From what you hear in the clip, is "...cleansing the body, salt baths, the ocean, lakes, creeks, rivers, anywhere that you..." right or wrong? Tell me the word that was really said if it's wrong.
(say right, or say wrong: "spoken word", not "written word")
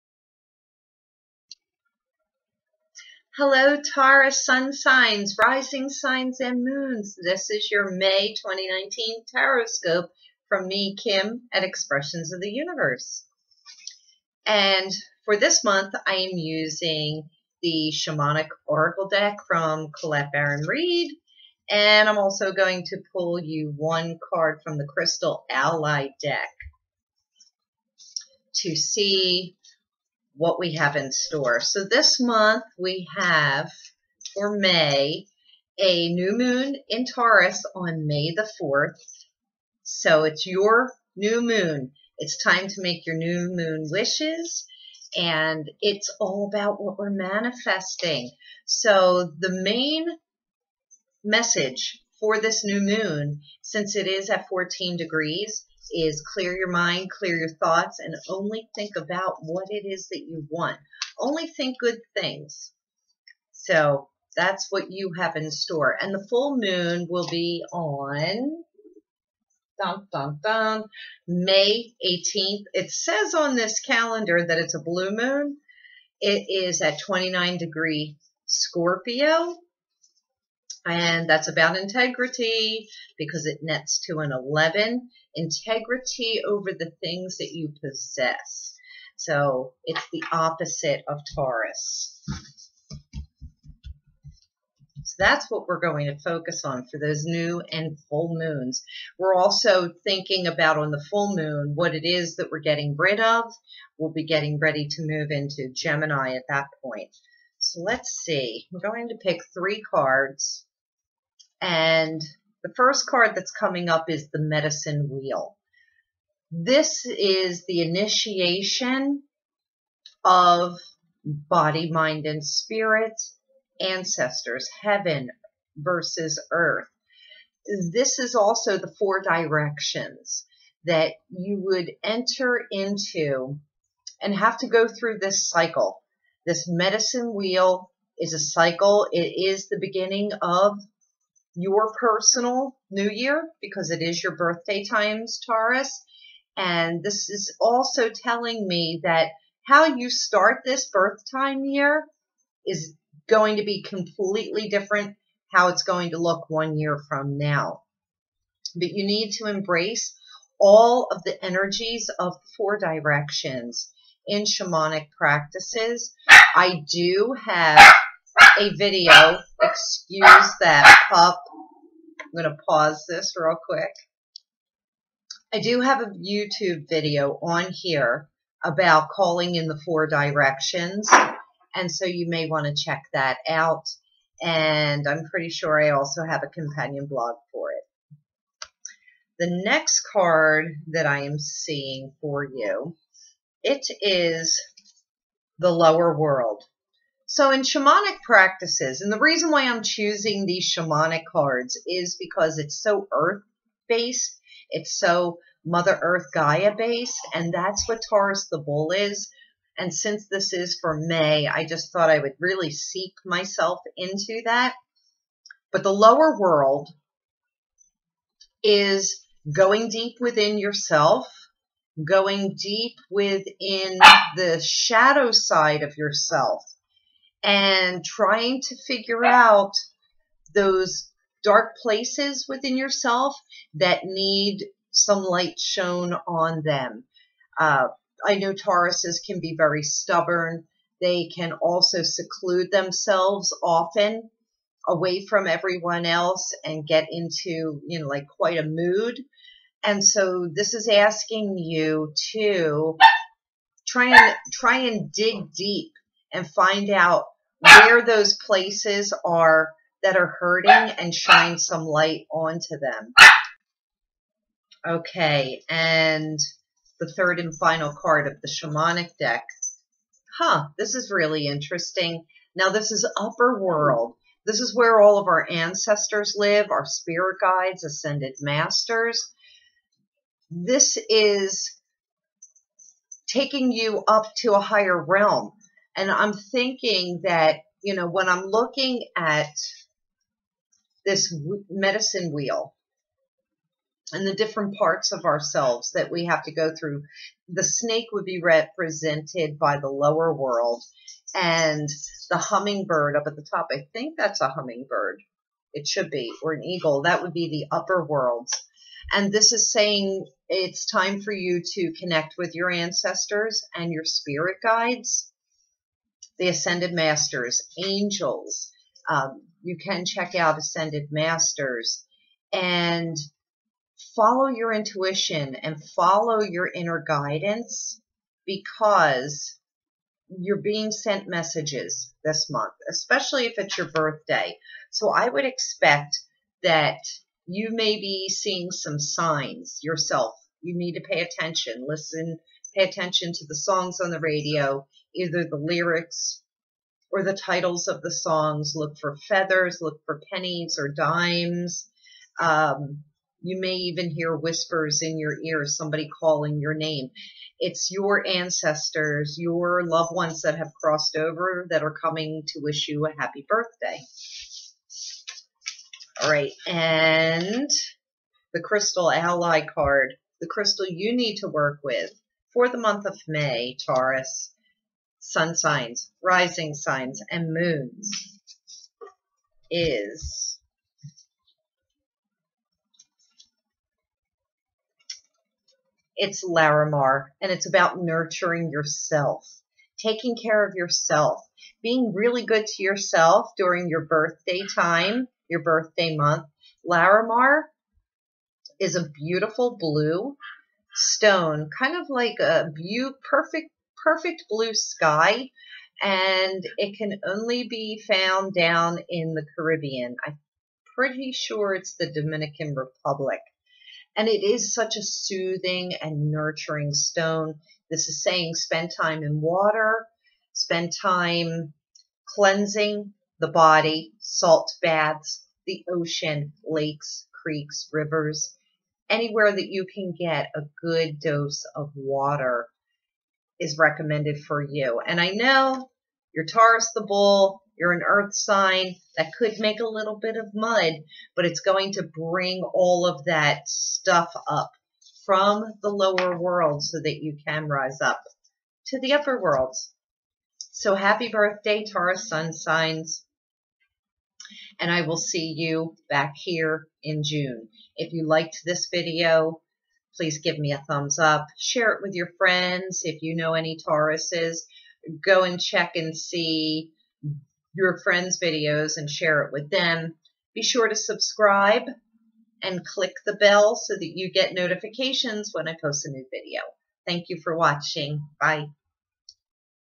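right.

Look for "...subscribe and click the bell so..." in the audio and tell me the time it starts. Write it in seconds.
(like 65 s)
470 s.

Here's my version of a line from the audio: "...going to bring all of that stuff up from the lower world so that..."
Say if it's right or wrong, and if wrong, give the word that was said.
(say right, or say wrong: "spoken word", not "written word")
right.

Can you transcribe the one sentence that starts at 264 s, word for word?
Okay, and the third and final card of the shamanic deck.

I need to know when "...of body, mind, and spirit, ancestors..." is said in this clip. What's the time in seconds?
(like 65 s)
120 s.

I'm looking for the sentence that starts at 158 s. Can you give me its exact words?
But you need to embrace all of the energies of the four directions in shamanic practices.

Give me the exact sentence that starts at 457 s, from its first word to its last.
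If you liked this video, please give me a thumbs up.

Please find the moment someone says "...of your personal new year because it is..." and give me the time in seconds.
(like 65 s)
140 s.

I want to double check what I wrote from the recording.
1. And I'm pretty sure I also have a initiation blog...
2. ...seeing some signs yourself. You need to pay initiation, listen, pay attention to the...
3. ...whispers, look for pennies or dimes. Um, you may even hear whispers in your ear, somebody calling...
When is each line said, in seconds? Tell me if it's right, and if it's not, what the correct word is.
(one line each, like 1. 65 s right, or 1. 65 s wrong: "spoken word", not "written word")
1. 184 s wrong: "companion", not "initiation"
2. 338 s wrong: "attention", not "initiation"
3. 349 s wrong: "feathers", not "whispers".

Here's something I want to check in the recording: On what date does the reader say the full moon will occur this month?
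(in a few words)
May 18th.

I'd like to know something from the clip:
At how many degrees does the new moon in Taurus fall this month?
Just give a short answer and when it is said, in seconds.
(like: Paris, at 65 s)
14, at 54 s.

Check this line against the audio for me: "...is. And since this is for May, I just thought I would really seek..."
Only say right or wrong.
right.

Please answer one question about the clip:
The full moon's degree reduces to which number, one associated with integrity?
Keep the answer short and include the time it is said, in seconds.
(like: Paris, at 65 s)
11, at 84 s.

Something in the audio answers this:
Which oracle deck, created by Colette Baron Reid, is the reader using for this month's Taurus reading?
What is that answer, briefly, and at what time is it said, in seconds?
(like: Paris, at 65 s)
Shamanic Oracle, at 17 s.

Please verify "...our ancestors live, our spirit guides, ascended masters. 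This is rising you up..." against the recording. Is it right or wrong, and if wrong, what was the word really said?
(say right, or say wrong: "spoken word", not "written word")
wrong: "taking", not "rising".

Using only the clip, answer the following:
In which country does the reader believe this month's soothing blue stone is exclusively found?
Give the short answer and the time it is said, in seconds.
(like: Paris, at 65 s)
Dominican Republic, at 412 s.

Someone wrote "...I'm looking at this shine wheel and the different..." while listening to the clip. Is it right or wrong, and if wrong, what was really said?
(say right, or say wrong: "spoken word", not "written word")
wrong: "medicine", not "shine".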